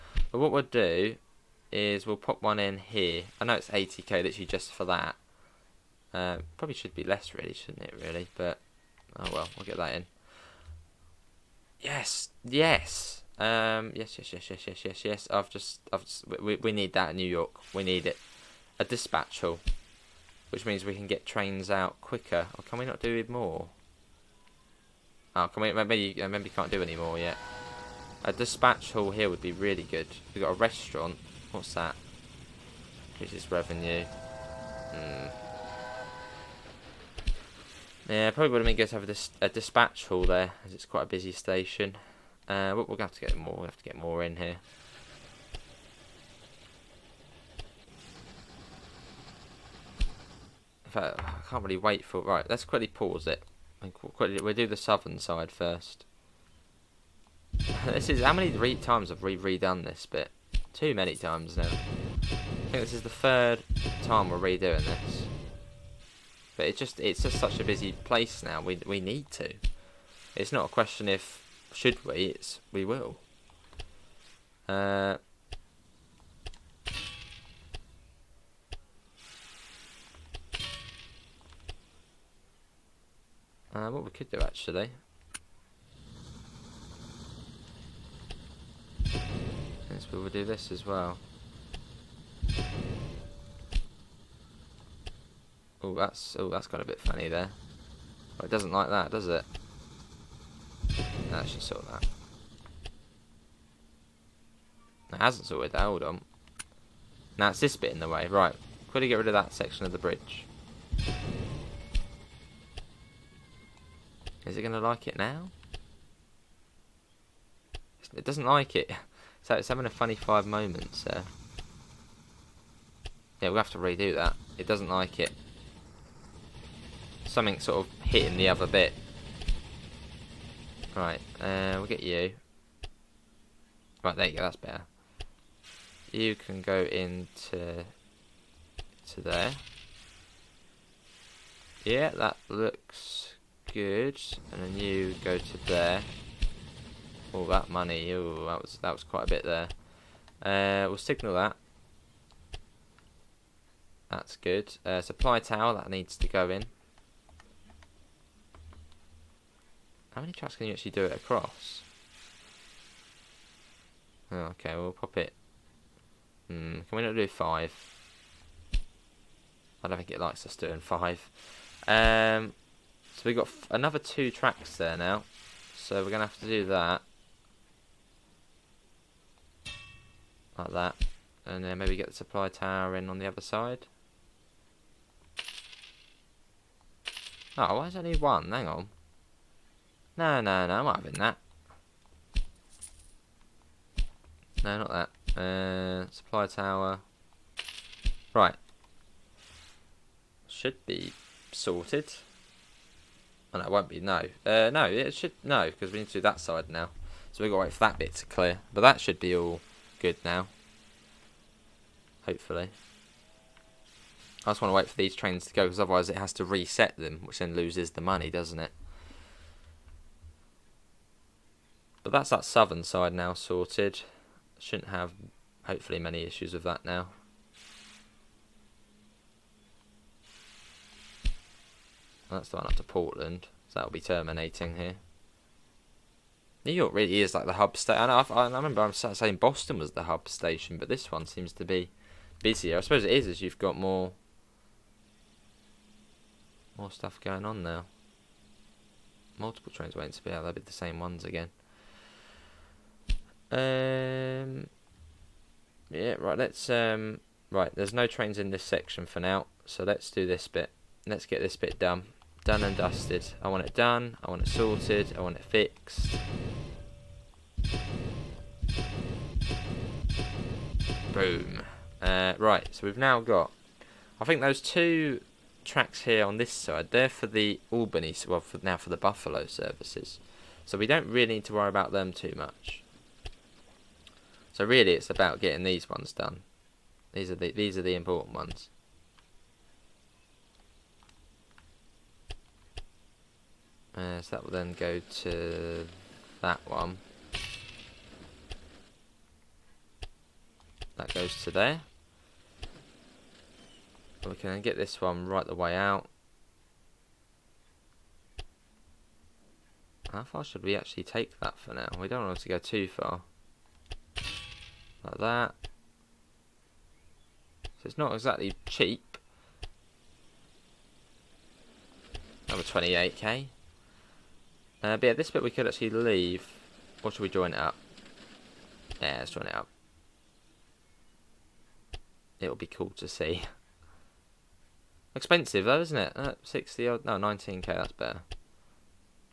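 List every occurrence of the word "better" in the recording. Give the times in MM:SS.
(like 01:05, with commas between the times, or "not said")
02:14, 05:37.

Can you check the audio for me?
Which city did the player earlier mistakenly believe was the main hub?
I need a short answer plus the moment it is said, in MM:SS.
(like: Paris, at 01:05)
Boston, at 03:59.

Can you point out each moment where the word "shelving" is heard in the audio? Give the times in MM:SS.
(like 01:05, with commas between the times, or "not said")
not said.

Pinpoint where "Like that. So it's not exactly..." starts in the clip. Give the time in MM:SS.
05:15.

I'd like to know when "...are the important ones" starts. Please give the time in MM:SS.
04:47.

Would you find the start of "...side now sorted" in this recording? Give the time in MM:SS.
03:42.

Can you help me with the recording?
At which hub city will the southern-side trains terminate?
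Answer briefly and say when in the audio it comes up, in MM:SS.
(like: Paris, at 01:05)
Portland, at 03:52.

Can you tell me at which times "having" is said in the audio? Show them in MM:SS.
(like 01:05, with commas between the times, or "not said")
01:59, 03:10.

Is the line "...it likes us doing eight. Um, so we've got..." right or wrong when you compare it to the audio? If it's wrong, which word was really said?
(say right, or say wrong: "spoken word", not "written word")
wrong: "five", not "eight".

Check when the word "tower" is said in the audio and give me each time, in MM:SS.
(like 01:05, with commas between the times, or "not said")
02:35, 03:02, 03:16.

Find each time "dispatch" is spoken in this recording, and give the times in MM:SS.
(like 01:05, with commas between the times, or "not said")
00:18, 00:28, 00:39.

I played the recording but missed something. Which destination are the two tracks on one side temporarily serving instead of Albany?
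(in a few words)
Buffalo.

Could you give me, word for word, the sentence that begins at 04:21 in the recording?
Let's get this bit done done and dusted.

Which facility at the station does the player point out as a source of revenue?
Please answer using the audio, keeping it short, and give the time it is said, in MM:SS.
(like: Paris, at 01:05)
Restaurant, at 00:30.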